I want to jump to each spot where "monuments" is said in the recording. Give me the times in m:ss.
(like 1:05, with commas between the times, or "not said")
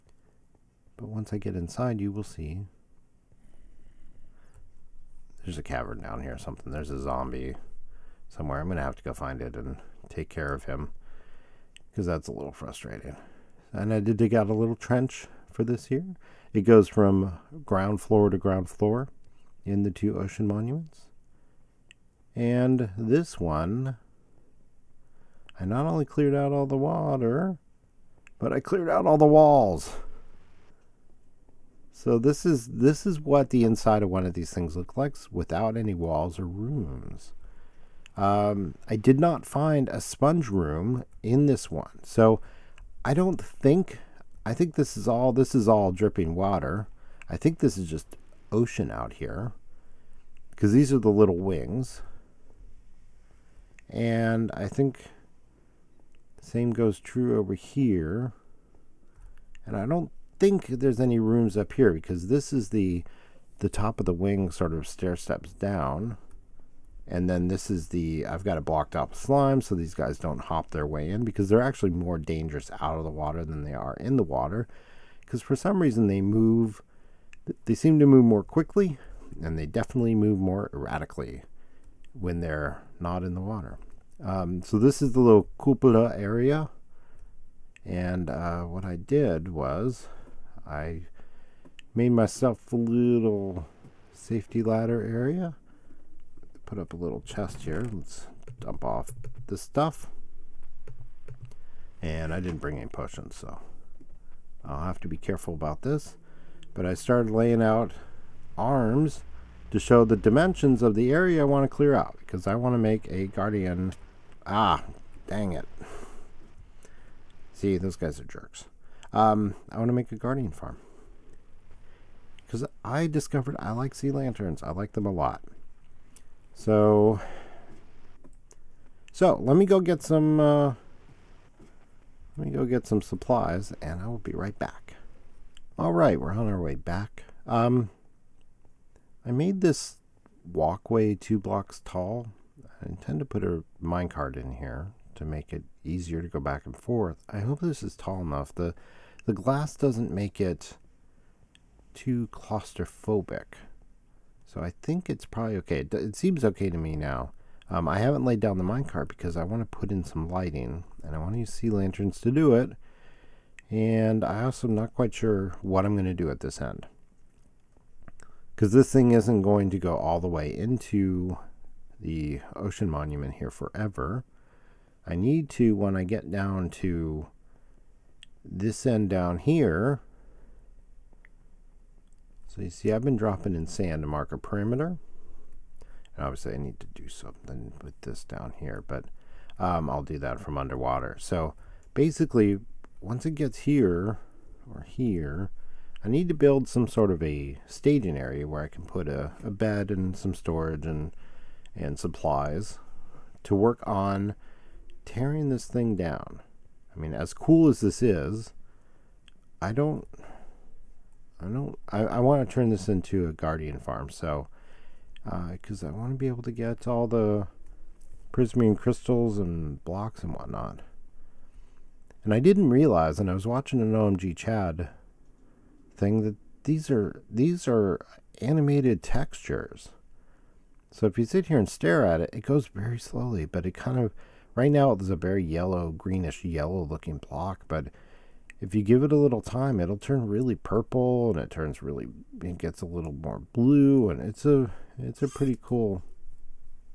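0:20, 2:52.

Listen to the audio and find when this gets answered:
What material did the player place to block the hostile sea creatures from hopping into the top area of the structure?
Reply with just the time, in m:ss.
1:09.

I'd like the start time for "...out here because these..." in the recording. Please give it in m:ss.
0:48.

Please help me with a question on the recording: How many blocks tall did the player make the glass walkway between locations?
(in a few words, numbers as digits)
2.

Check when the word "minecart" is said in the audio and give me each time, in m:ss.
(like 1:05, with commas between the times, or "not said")
2:23, 2:38.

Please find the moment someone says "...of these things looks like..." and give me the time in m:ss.
0:34.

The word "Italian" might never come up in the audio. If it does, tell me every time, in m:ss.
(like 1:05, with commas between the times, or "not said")
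not said.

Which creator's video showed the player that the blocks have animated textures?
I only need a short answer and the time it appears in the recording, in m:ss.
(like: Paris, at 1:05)
OMGchad, at 3:43.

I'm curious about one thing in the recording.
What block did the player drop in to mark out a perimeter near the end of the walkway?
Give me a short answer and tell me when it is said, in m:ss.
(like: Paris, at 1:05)
Sand, at 3:03.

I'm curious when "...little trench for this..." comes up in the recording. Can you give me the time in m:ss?
0:14.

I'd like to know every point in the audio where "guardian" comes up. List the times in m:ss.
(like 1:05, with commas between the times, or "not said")
1:53, 2:00, 3:33.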